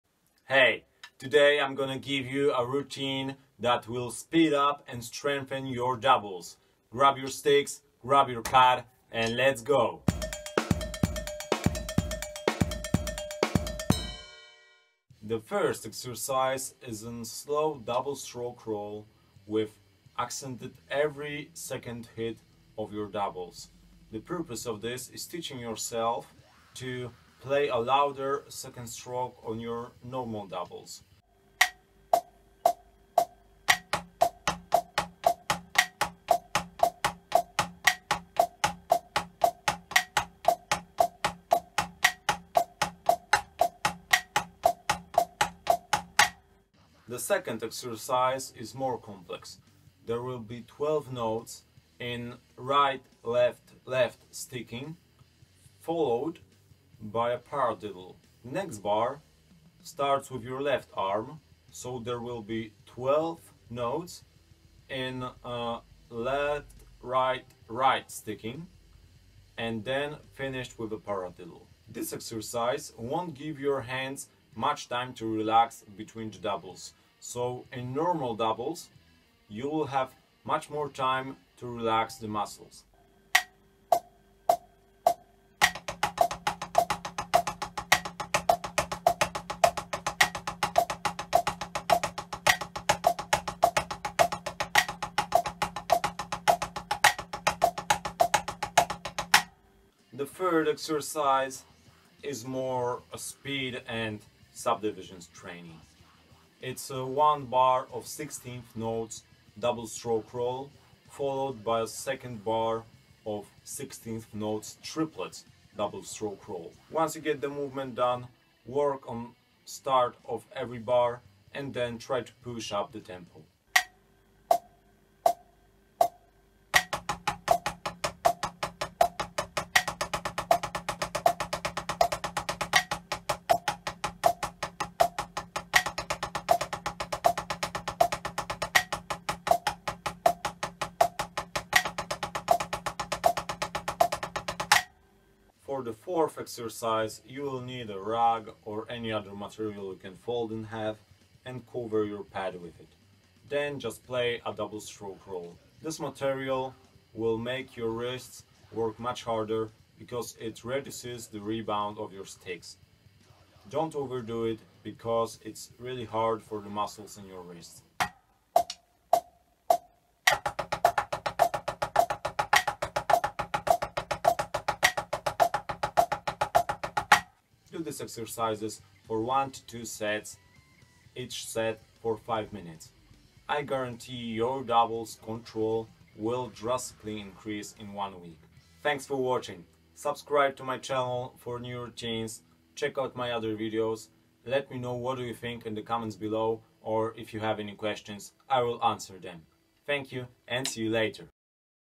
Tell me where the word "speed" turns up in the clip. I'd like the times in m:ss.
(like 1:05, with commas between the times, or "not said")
0:04, 1:43.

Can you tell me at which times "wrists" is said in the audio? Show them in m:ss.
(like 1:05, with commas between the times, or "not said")
2:37, 2:47.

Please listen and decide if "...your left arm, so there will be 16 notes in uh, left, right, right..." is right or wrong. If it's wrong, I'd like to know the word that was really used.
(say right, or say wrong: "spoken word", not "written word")
wrong: "12", not "16".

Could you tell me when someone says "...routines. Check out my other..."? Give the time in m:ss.
3:11.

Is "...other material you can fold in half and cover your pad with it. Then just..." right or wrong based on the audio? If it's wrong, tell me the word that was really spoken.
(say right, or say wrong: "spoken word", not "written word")
right.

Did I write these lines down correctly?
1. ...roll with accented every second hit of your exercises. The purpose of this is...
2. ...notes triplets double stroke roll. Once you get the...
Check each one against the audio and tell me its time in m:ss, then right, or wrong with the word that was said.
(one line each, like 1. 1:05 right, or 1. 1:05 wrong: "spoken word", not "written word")
1. 0:18 wrong: "doubles", not "exercises"
2. 1:54 right.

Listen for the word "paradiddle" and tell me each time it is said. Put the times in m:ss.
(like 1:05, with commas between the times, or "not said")
0:57, 1:10.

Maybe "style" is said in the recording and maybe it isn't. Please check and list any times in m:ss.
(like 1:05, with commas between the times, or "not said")
not said.